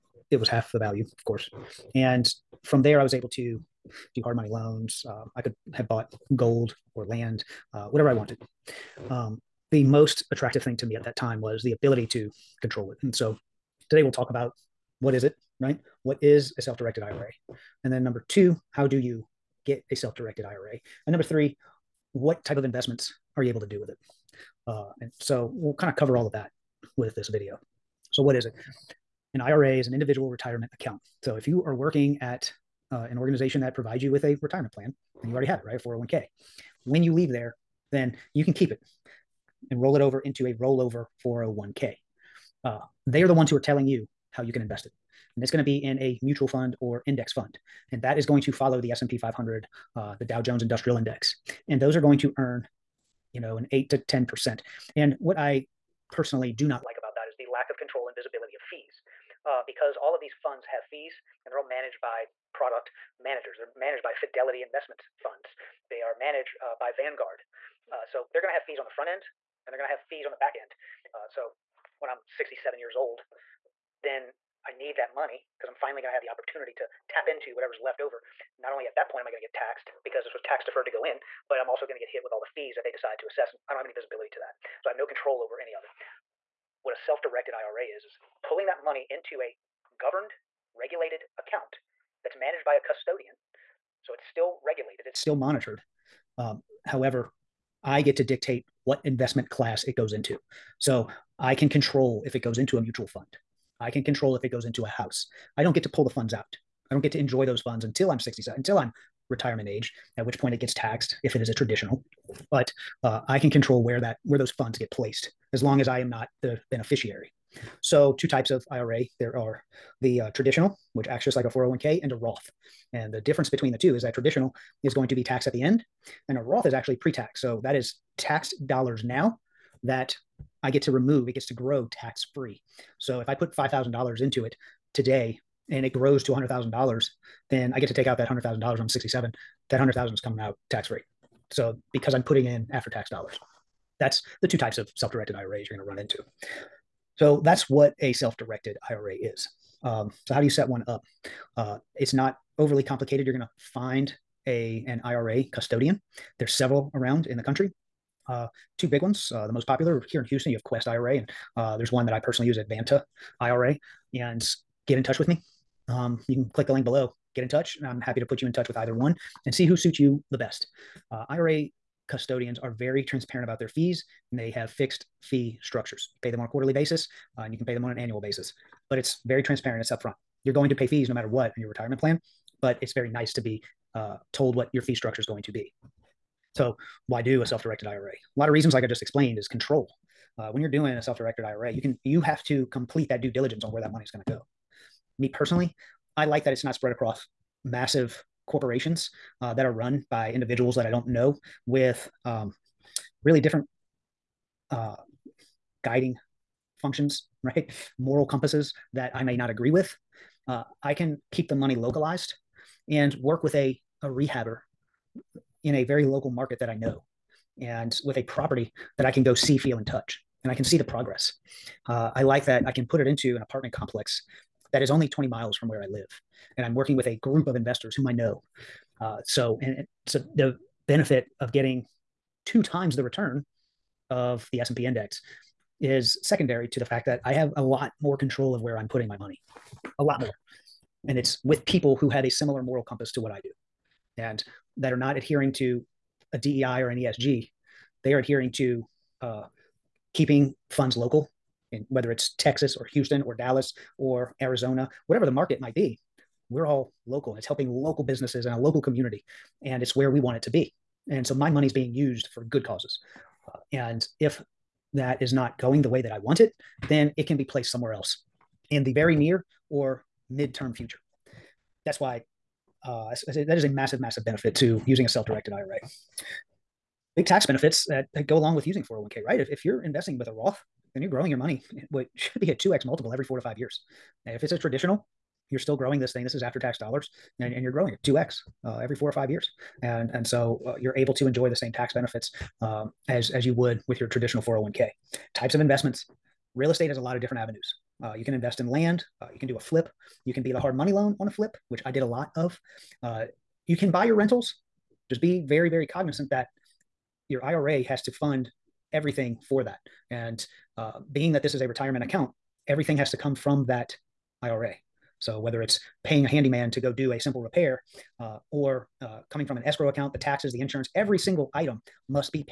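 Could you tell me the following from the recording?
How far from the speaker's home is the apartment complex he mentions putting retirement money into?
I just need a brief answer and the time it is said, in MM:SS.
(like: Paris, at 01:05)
20 miles, at 03:45.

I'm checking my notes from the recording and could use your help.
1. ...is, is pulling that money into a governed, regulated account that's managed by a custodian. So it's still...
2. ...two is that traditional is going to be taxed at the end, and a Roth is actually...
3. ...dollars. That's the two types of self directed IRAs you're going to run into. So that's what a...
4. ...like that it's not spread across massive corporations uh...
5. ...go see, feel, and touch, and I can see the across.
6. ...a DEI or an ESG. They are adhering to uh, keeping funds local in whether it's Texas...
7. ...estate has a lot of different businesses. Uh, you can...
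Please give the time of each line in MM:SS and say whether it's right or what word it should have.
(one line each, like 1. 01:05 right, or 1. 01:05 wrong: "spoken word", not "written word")
1. 01:27 right
2. 02:03 right
3. 02:23 right
4. 03:16 right
5. 03:39 wrong: "progress", not "across"
6. 04:06 right
7. 04:56 wrong: "avenues", not "businesses".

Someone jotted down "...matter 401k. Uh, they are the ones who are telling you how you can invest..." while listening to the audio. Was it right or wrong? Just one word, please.
wrong.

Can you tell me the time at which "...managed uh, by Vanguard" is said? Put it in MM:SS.
01:06.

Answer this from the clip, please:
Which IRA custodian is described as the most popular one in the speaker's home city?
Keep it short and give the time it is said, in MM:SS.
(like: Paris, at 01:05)
Quest IRA, at 02:40.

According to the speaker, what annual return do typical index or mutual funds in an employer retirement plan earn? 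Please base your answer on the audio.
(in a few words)
8 to 10%.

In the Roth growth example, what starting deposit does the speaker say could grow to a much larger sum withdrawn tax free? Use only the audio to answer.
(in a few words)
$5,000.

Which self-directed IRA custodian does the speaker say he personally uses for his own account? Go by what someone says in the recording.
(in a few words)
Advanta IRA.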